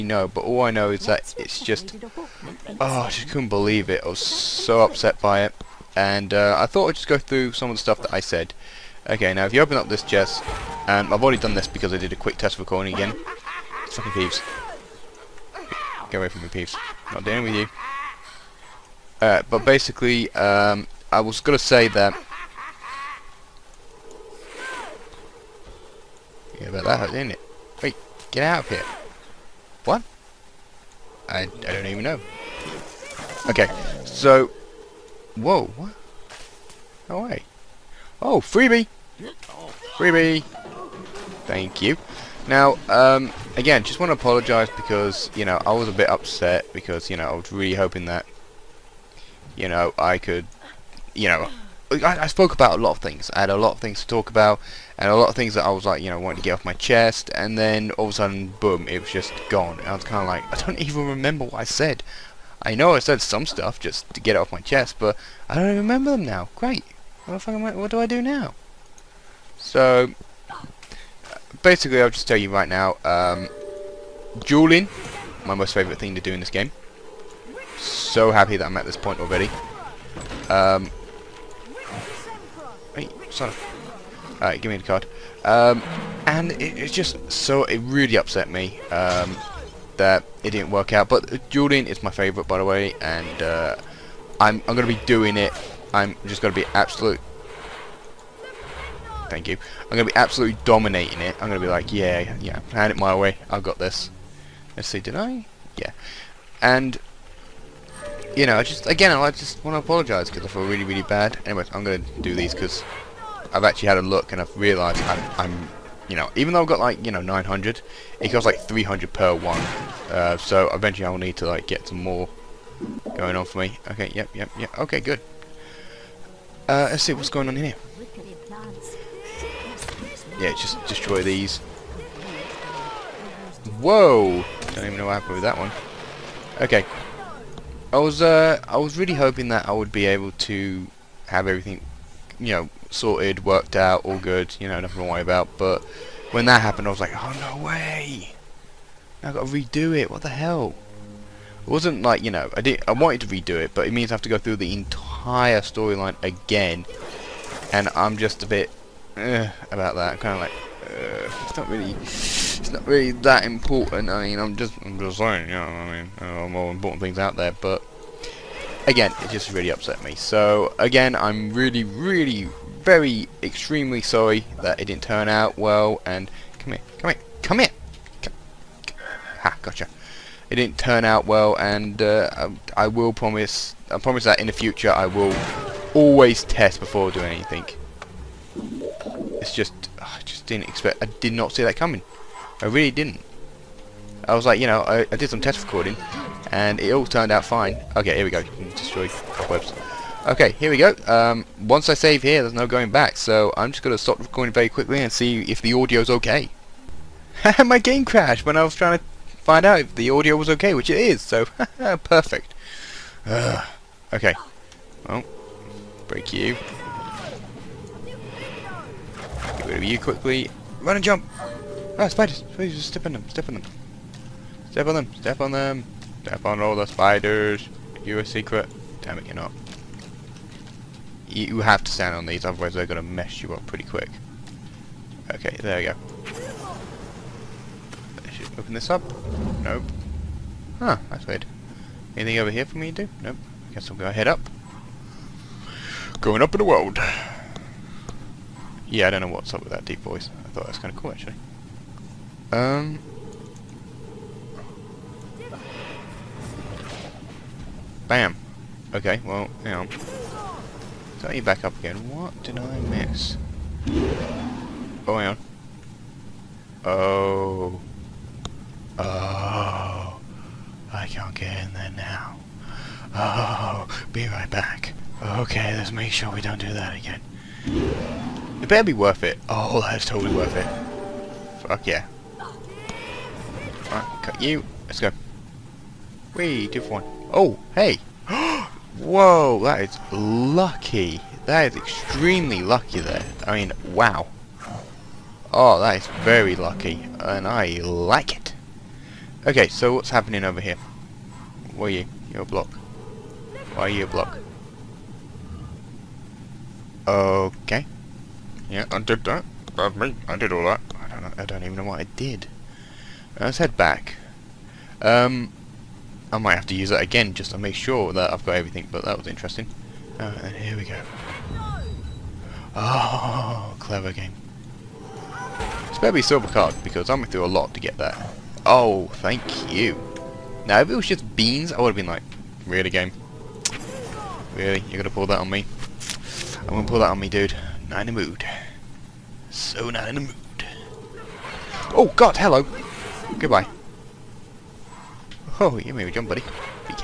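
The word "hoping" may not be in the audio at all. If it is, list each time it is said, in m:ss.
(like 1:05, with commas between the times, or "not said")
0:47, 2:19.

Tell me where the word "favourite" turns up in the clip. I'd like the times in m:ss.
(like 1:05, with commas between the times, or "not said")
1:15, 1:32.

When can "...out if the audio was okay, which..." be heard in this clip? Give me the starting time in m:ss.
3:29.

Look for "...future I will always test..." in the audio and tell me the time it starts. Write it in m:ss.
3:04.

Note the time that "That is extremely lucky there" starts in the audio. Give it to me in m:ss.
4:51.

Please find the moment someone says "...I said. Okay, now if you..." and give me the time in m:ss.
0:08.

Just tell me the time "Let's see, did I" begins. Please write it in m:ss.
1:44.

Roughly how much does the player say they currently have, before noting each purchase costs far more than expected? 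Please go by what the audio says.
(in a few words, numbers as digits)
900.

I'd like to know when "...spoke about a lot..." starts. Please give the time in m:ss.
0:52.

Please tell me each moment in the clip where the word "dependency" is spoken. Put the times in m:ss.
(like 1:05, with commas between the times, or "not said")
not said.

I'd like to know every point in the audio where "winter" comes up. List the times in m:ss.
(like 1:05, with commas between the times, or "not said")
not said.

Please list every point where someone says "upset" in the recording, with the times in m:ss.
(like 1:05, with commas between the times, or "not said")
0:04, 0:46, 1:28, 2:49.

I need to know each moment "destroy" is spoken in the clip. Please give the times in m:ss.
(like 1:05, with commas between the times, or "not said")
2:10, 3:18.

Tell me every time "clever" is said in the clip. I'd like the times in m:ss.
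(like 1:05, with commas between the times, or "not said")
5:23.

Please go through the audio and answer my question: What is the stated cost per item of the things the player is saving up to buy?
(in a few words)
300.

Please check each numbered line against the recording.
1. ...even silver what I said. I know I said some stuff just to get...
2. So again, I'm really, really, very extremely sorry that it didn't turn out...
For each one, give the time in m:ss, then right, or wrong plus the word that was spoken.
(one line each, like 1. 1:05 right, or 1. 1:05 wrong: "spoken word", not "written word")
1. 1:00 wrong: "remember", not "silver"
2. 2:50 right.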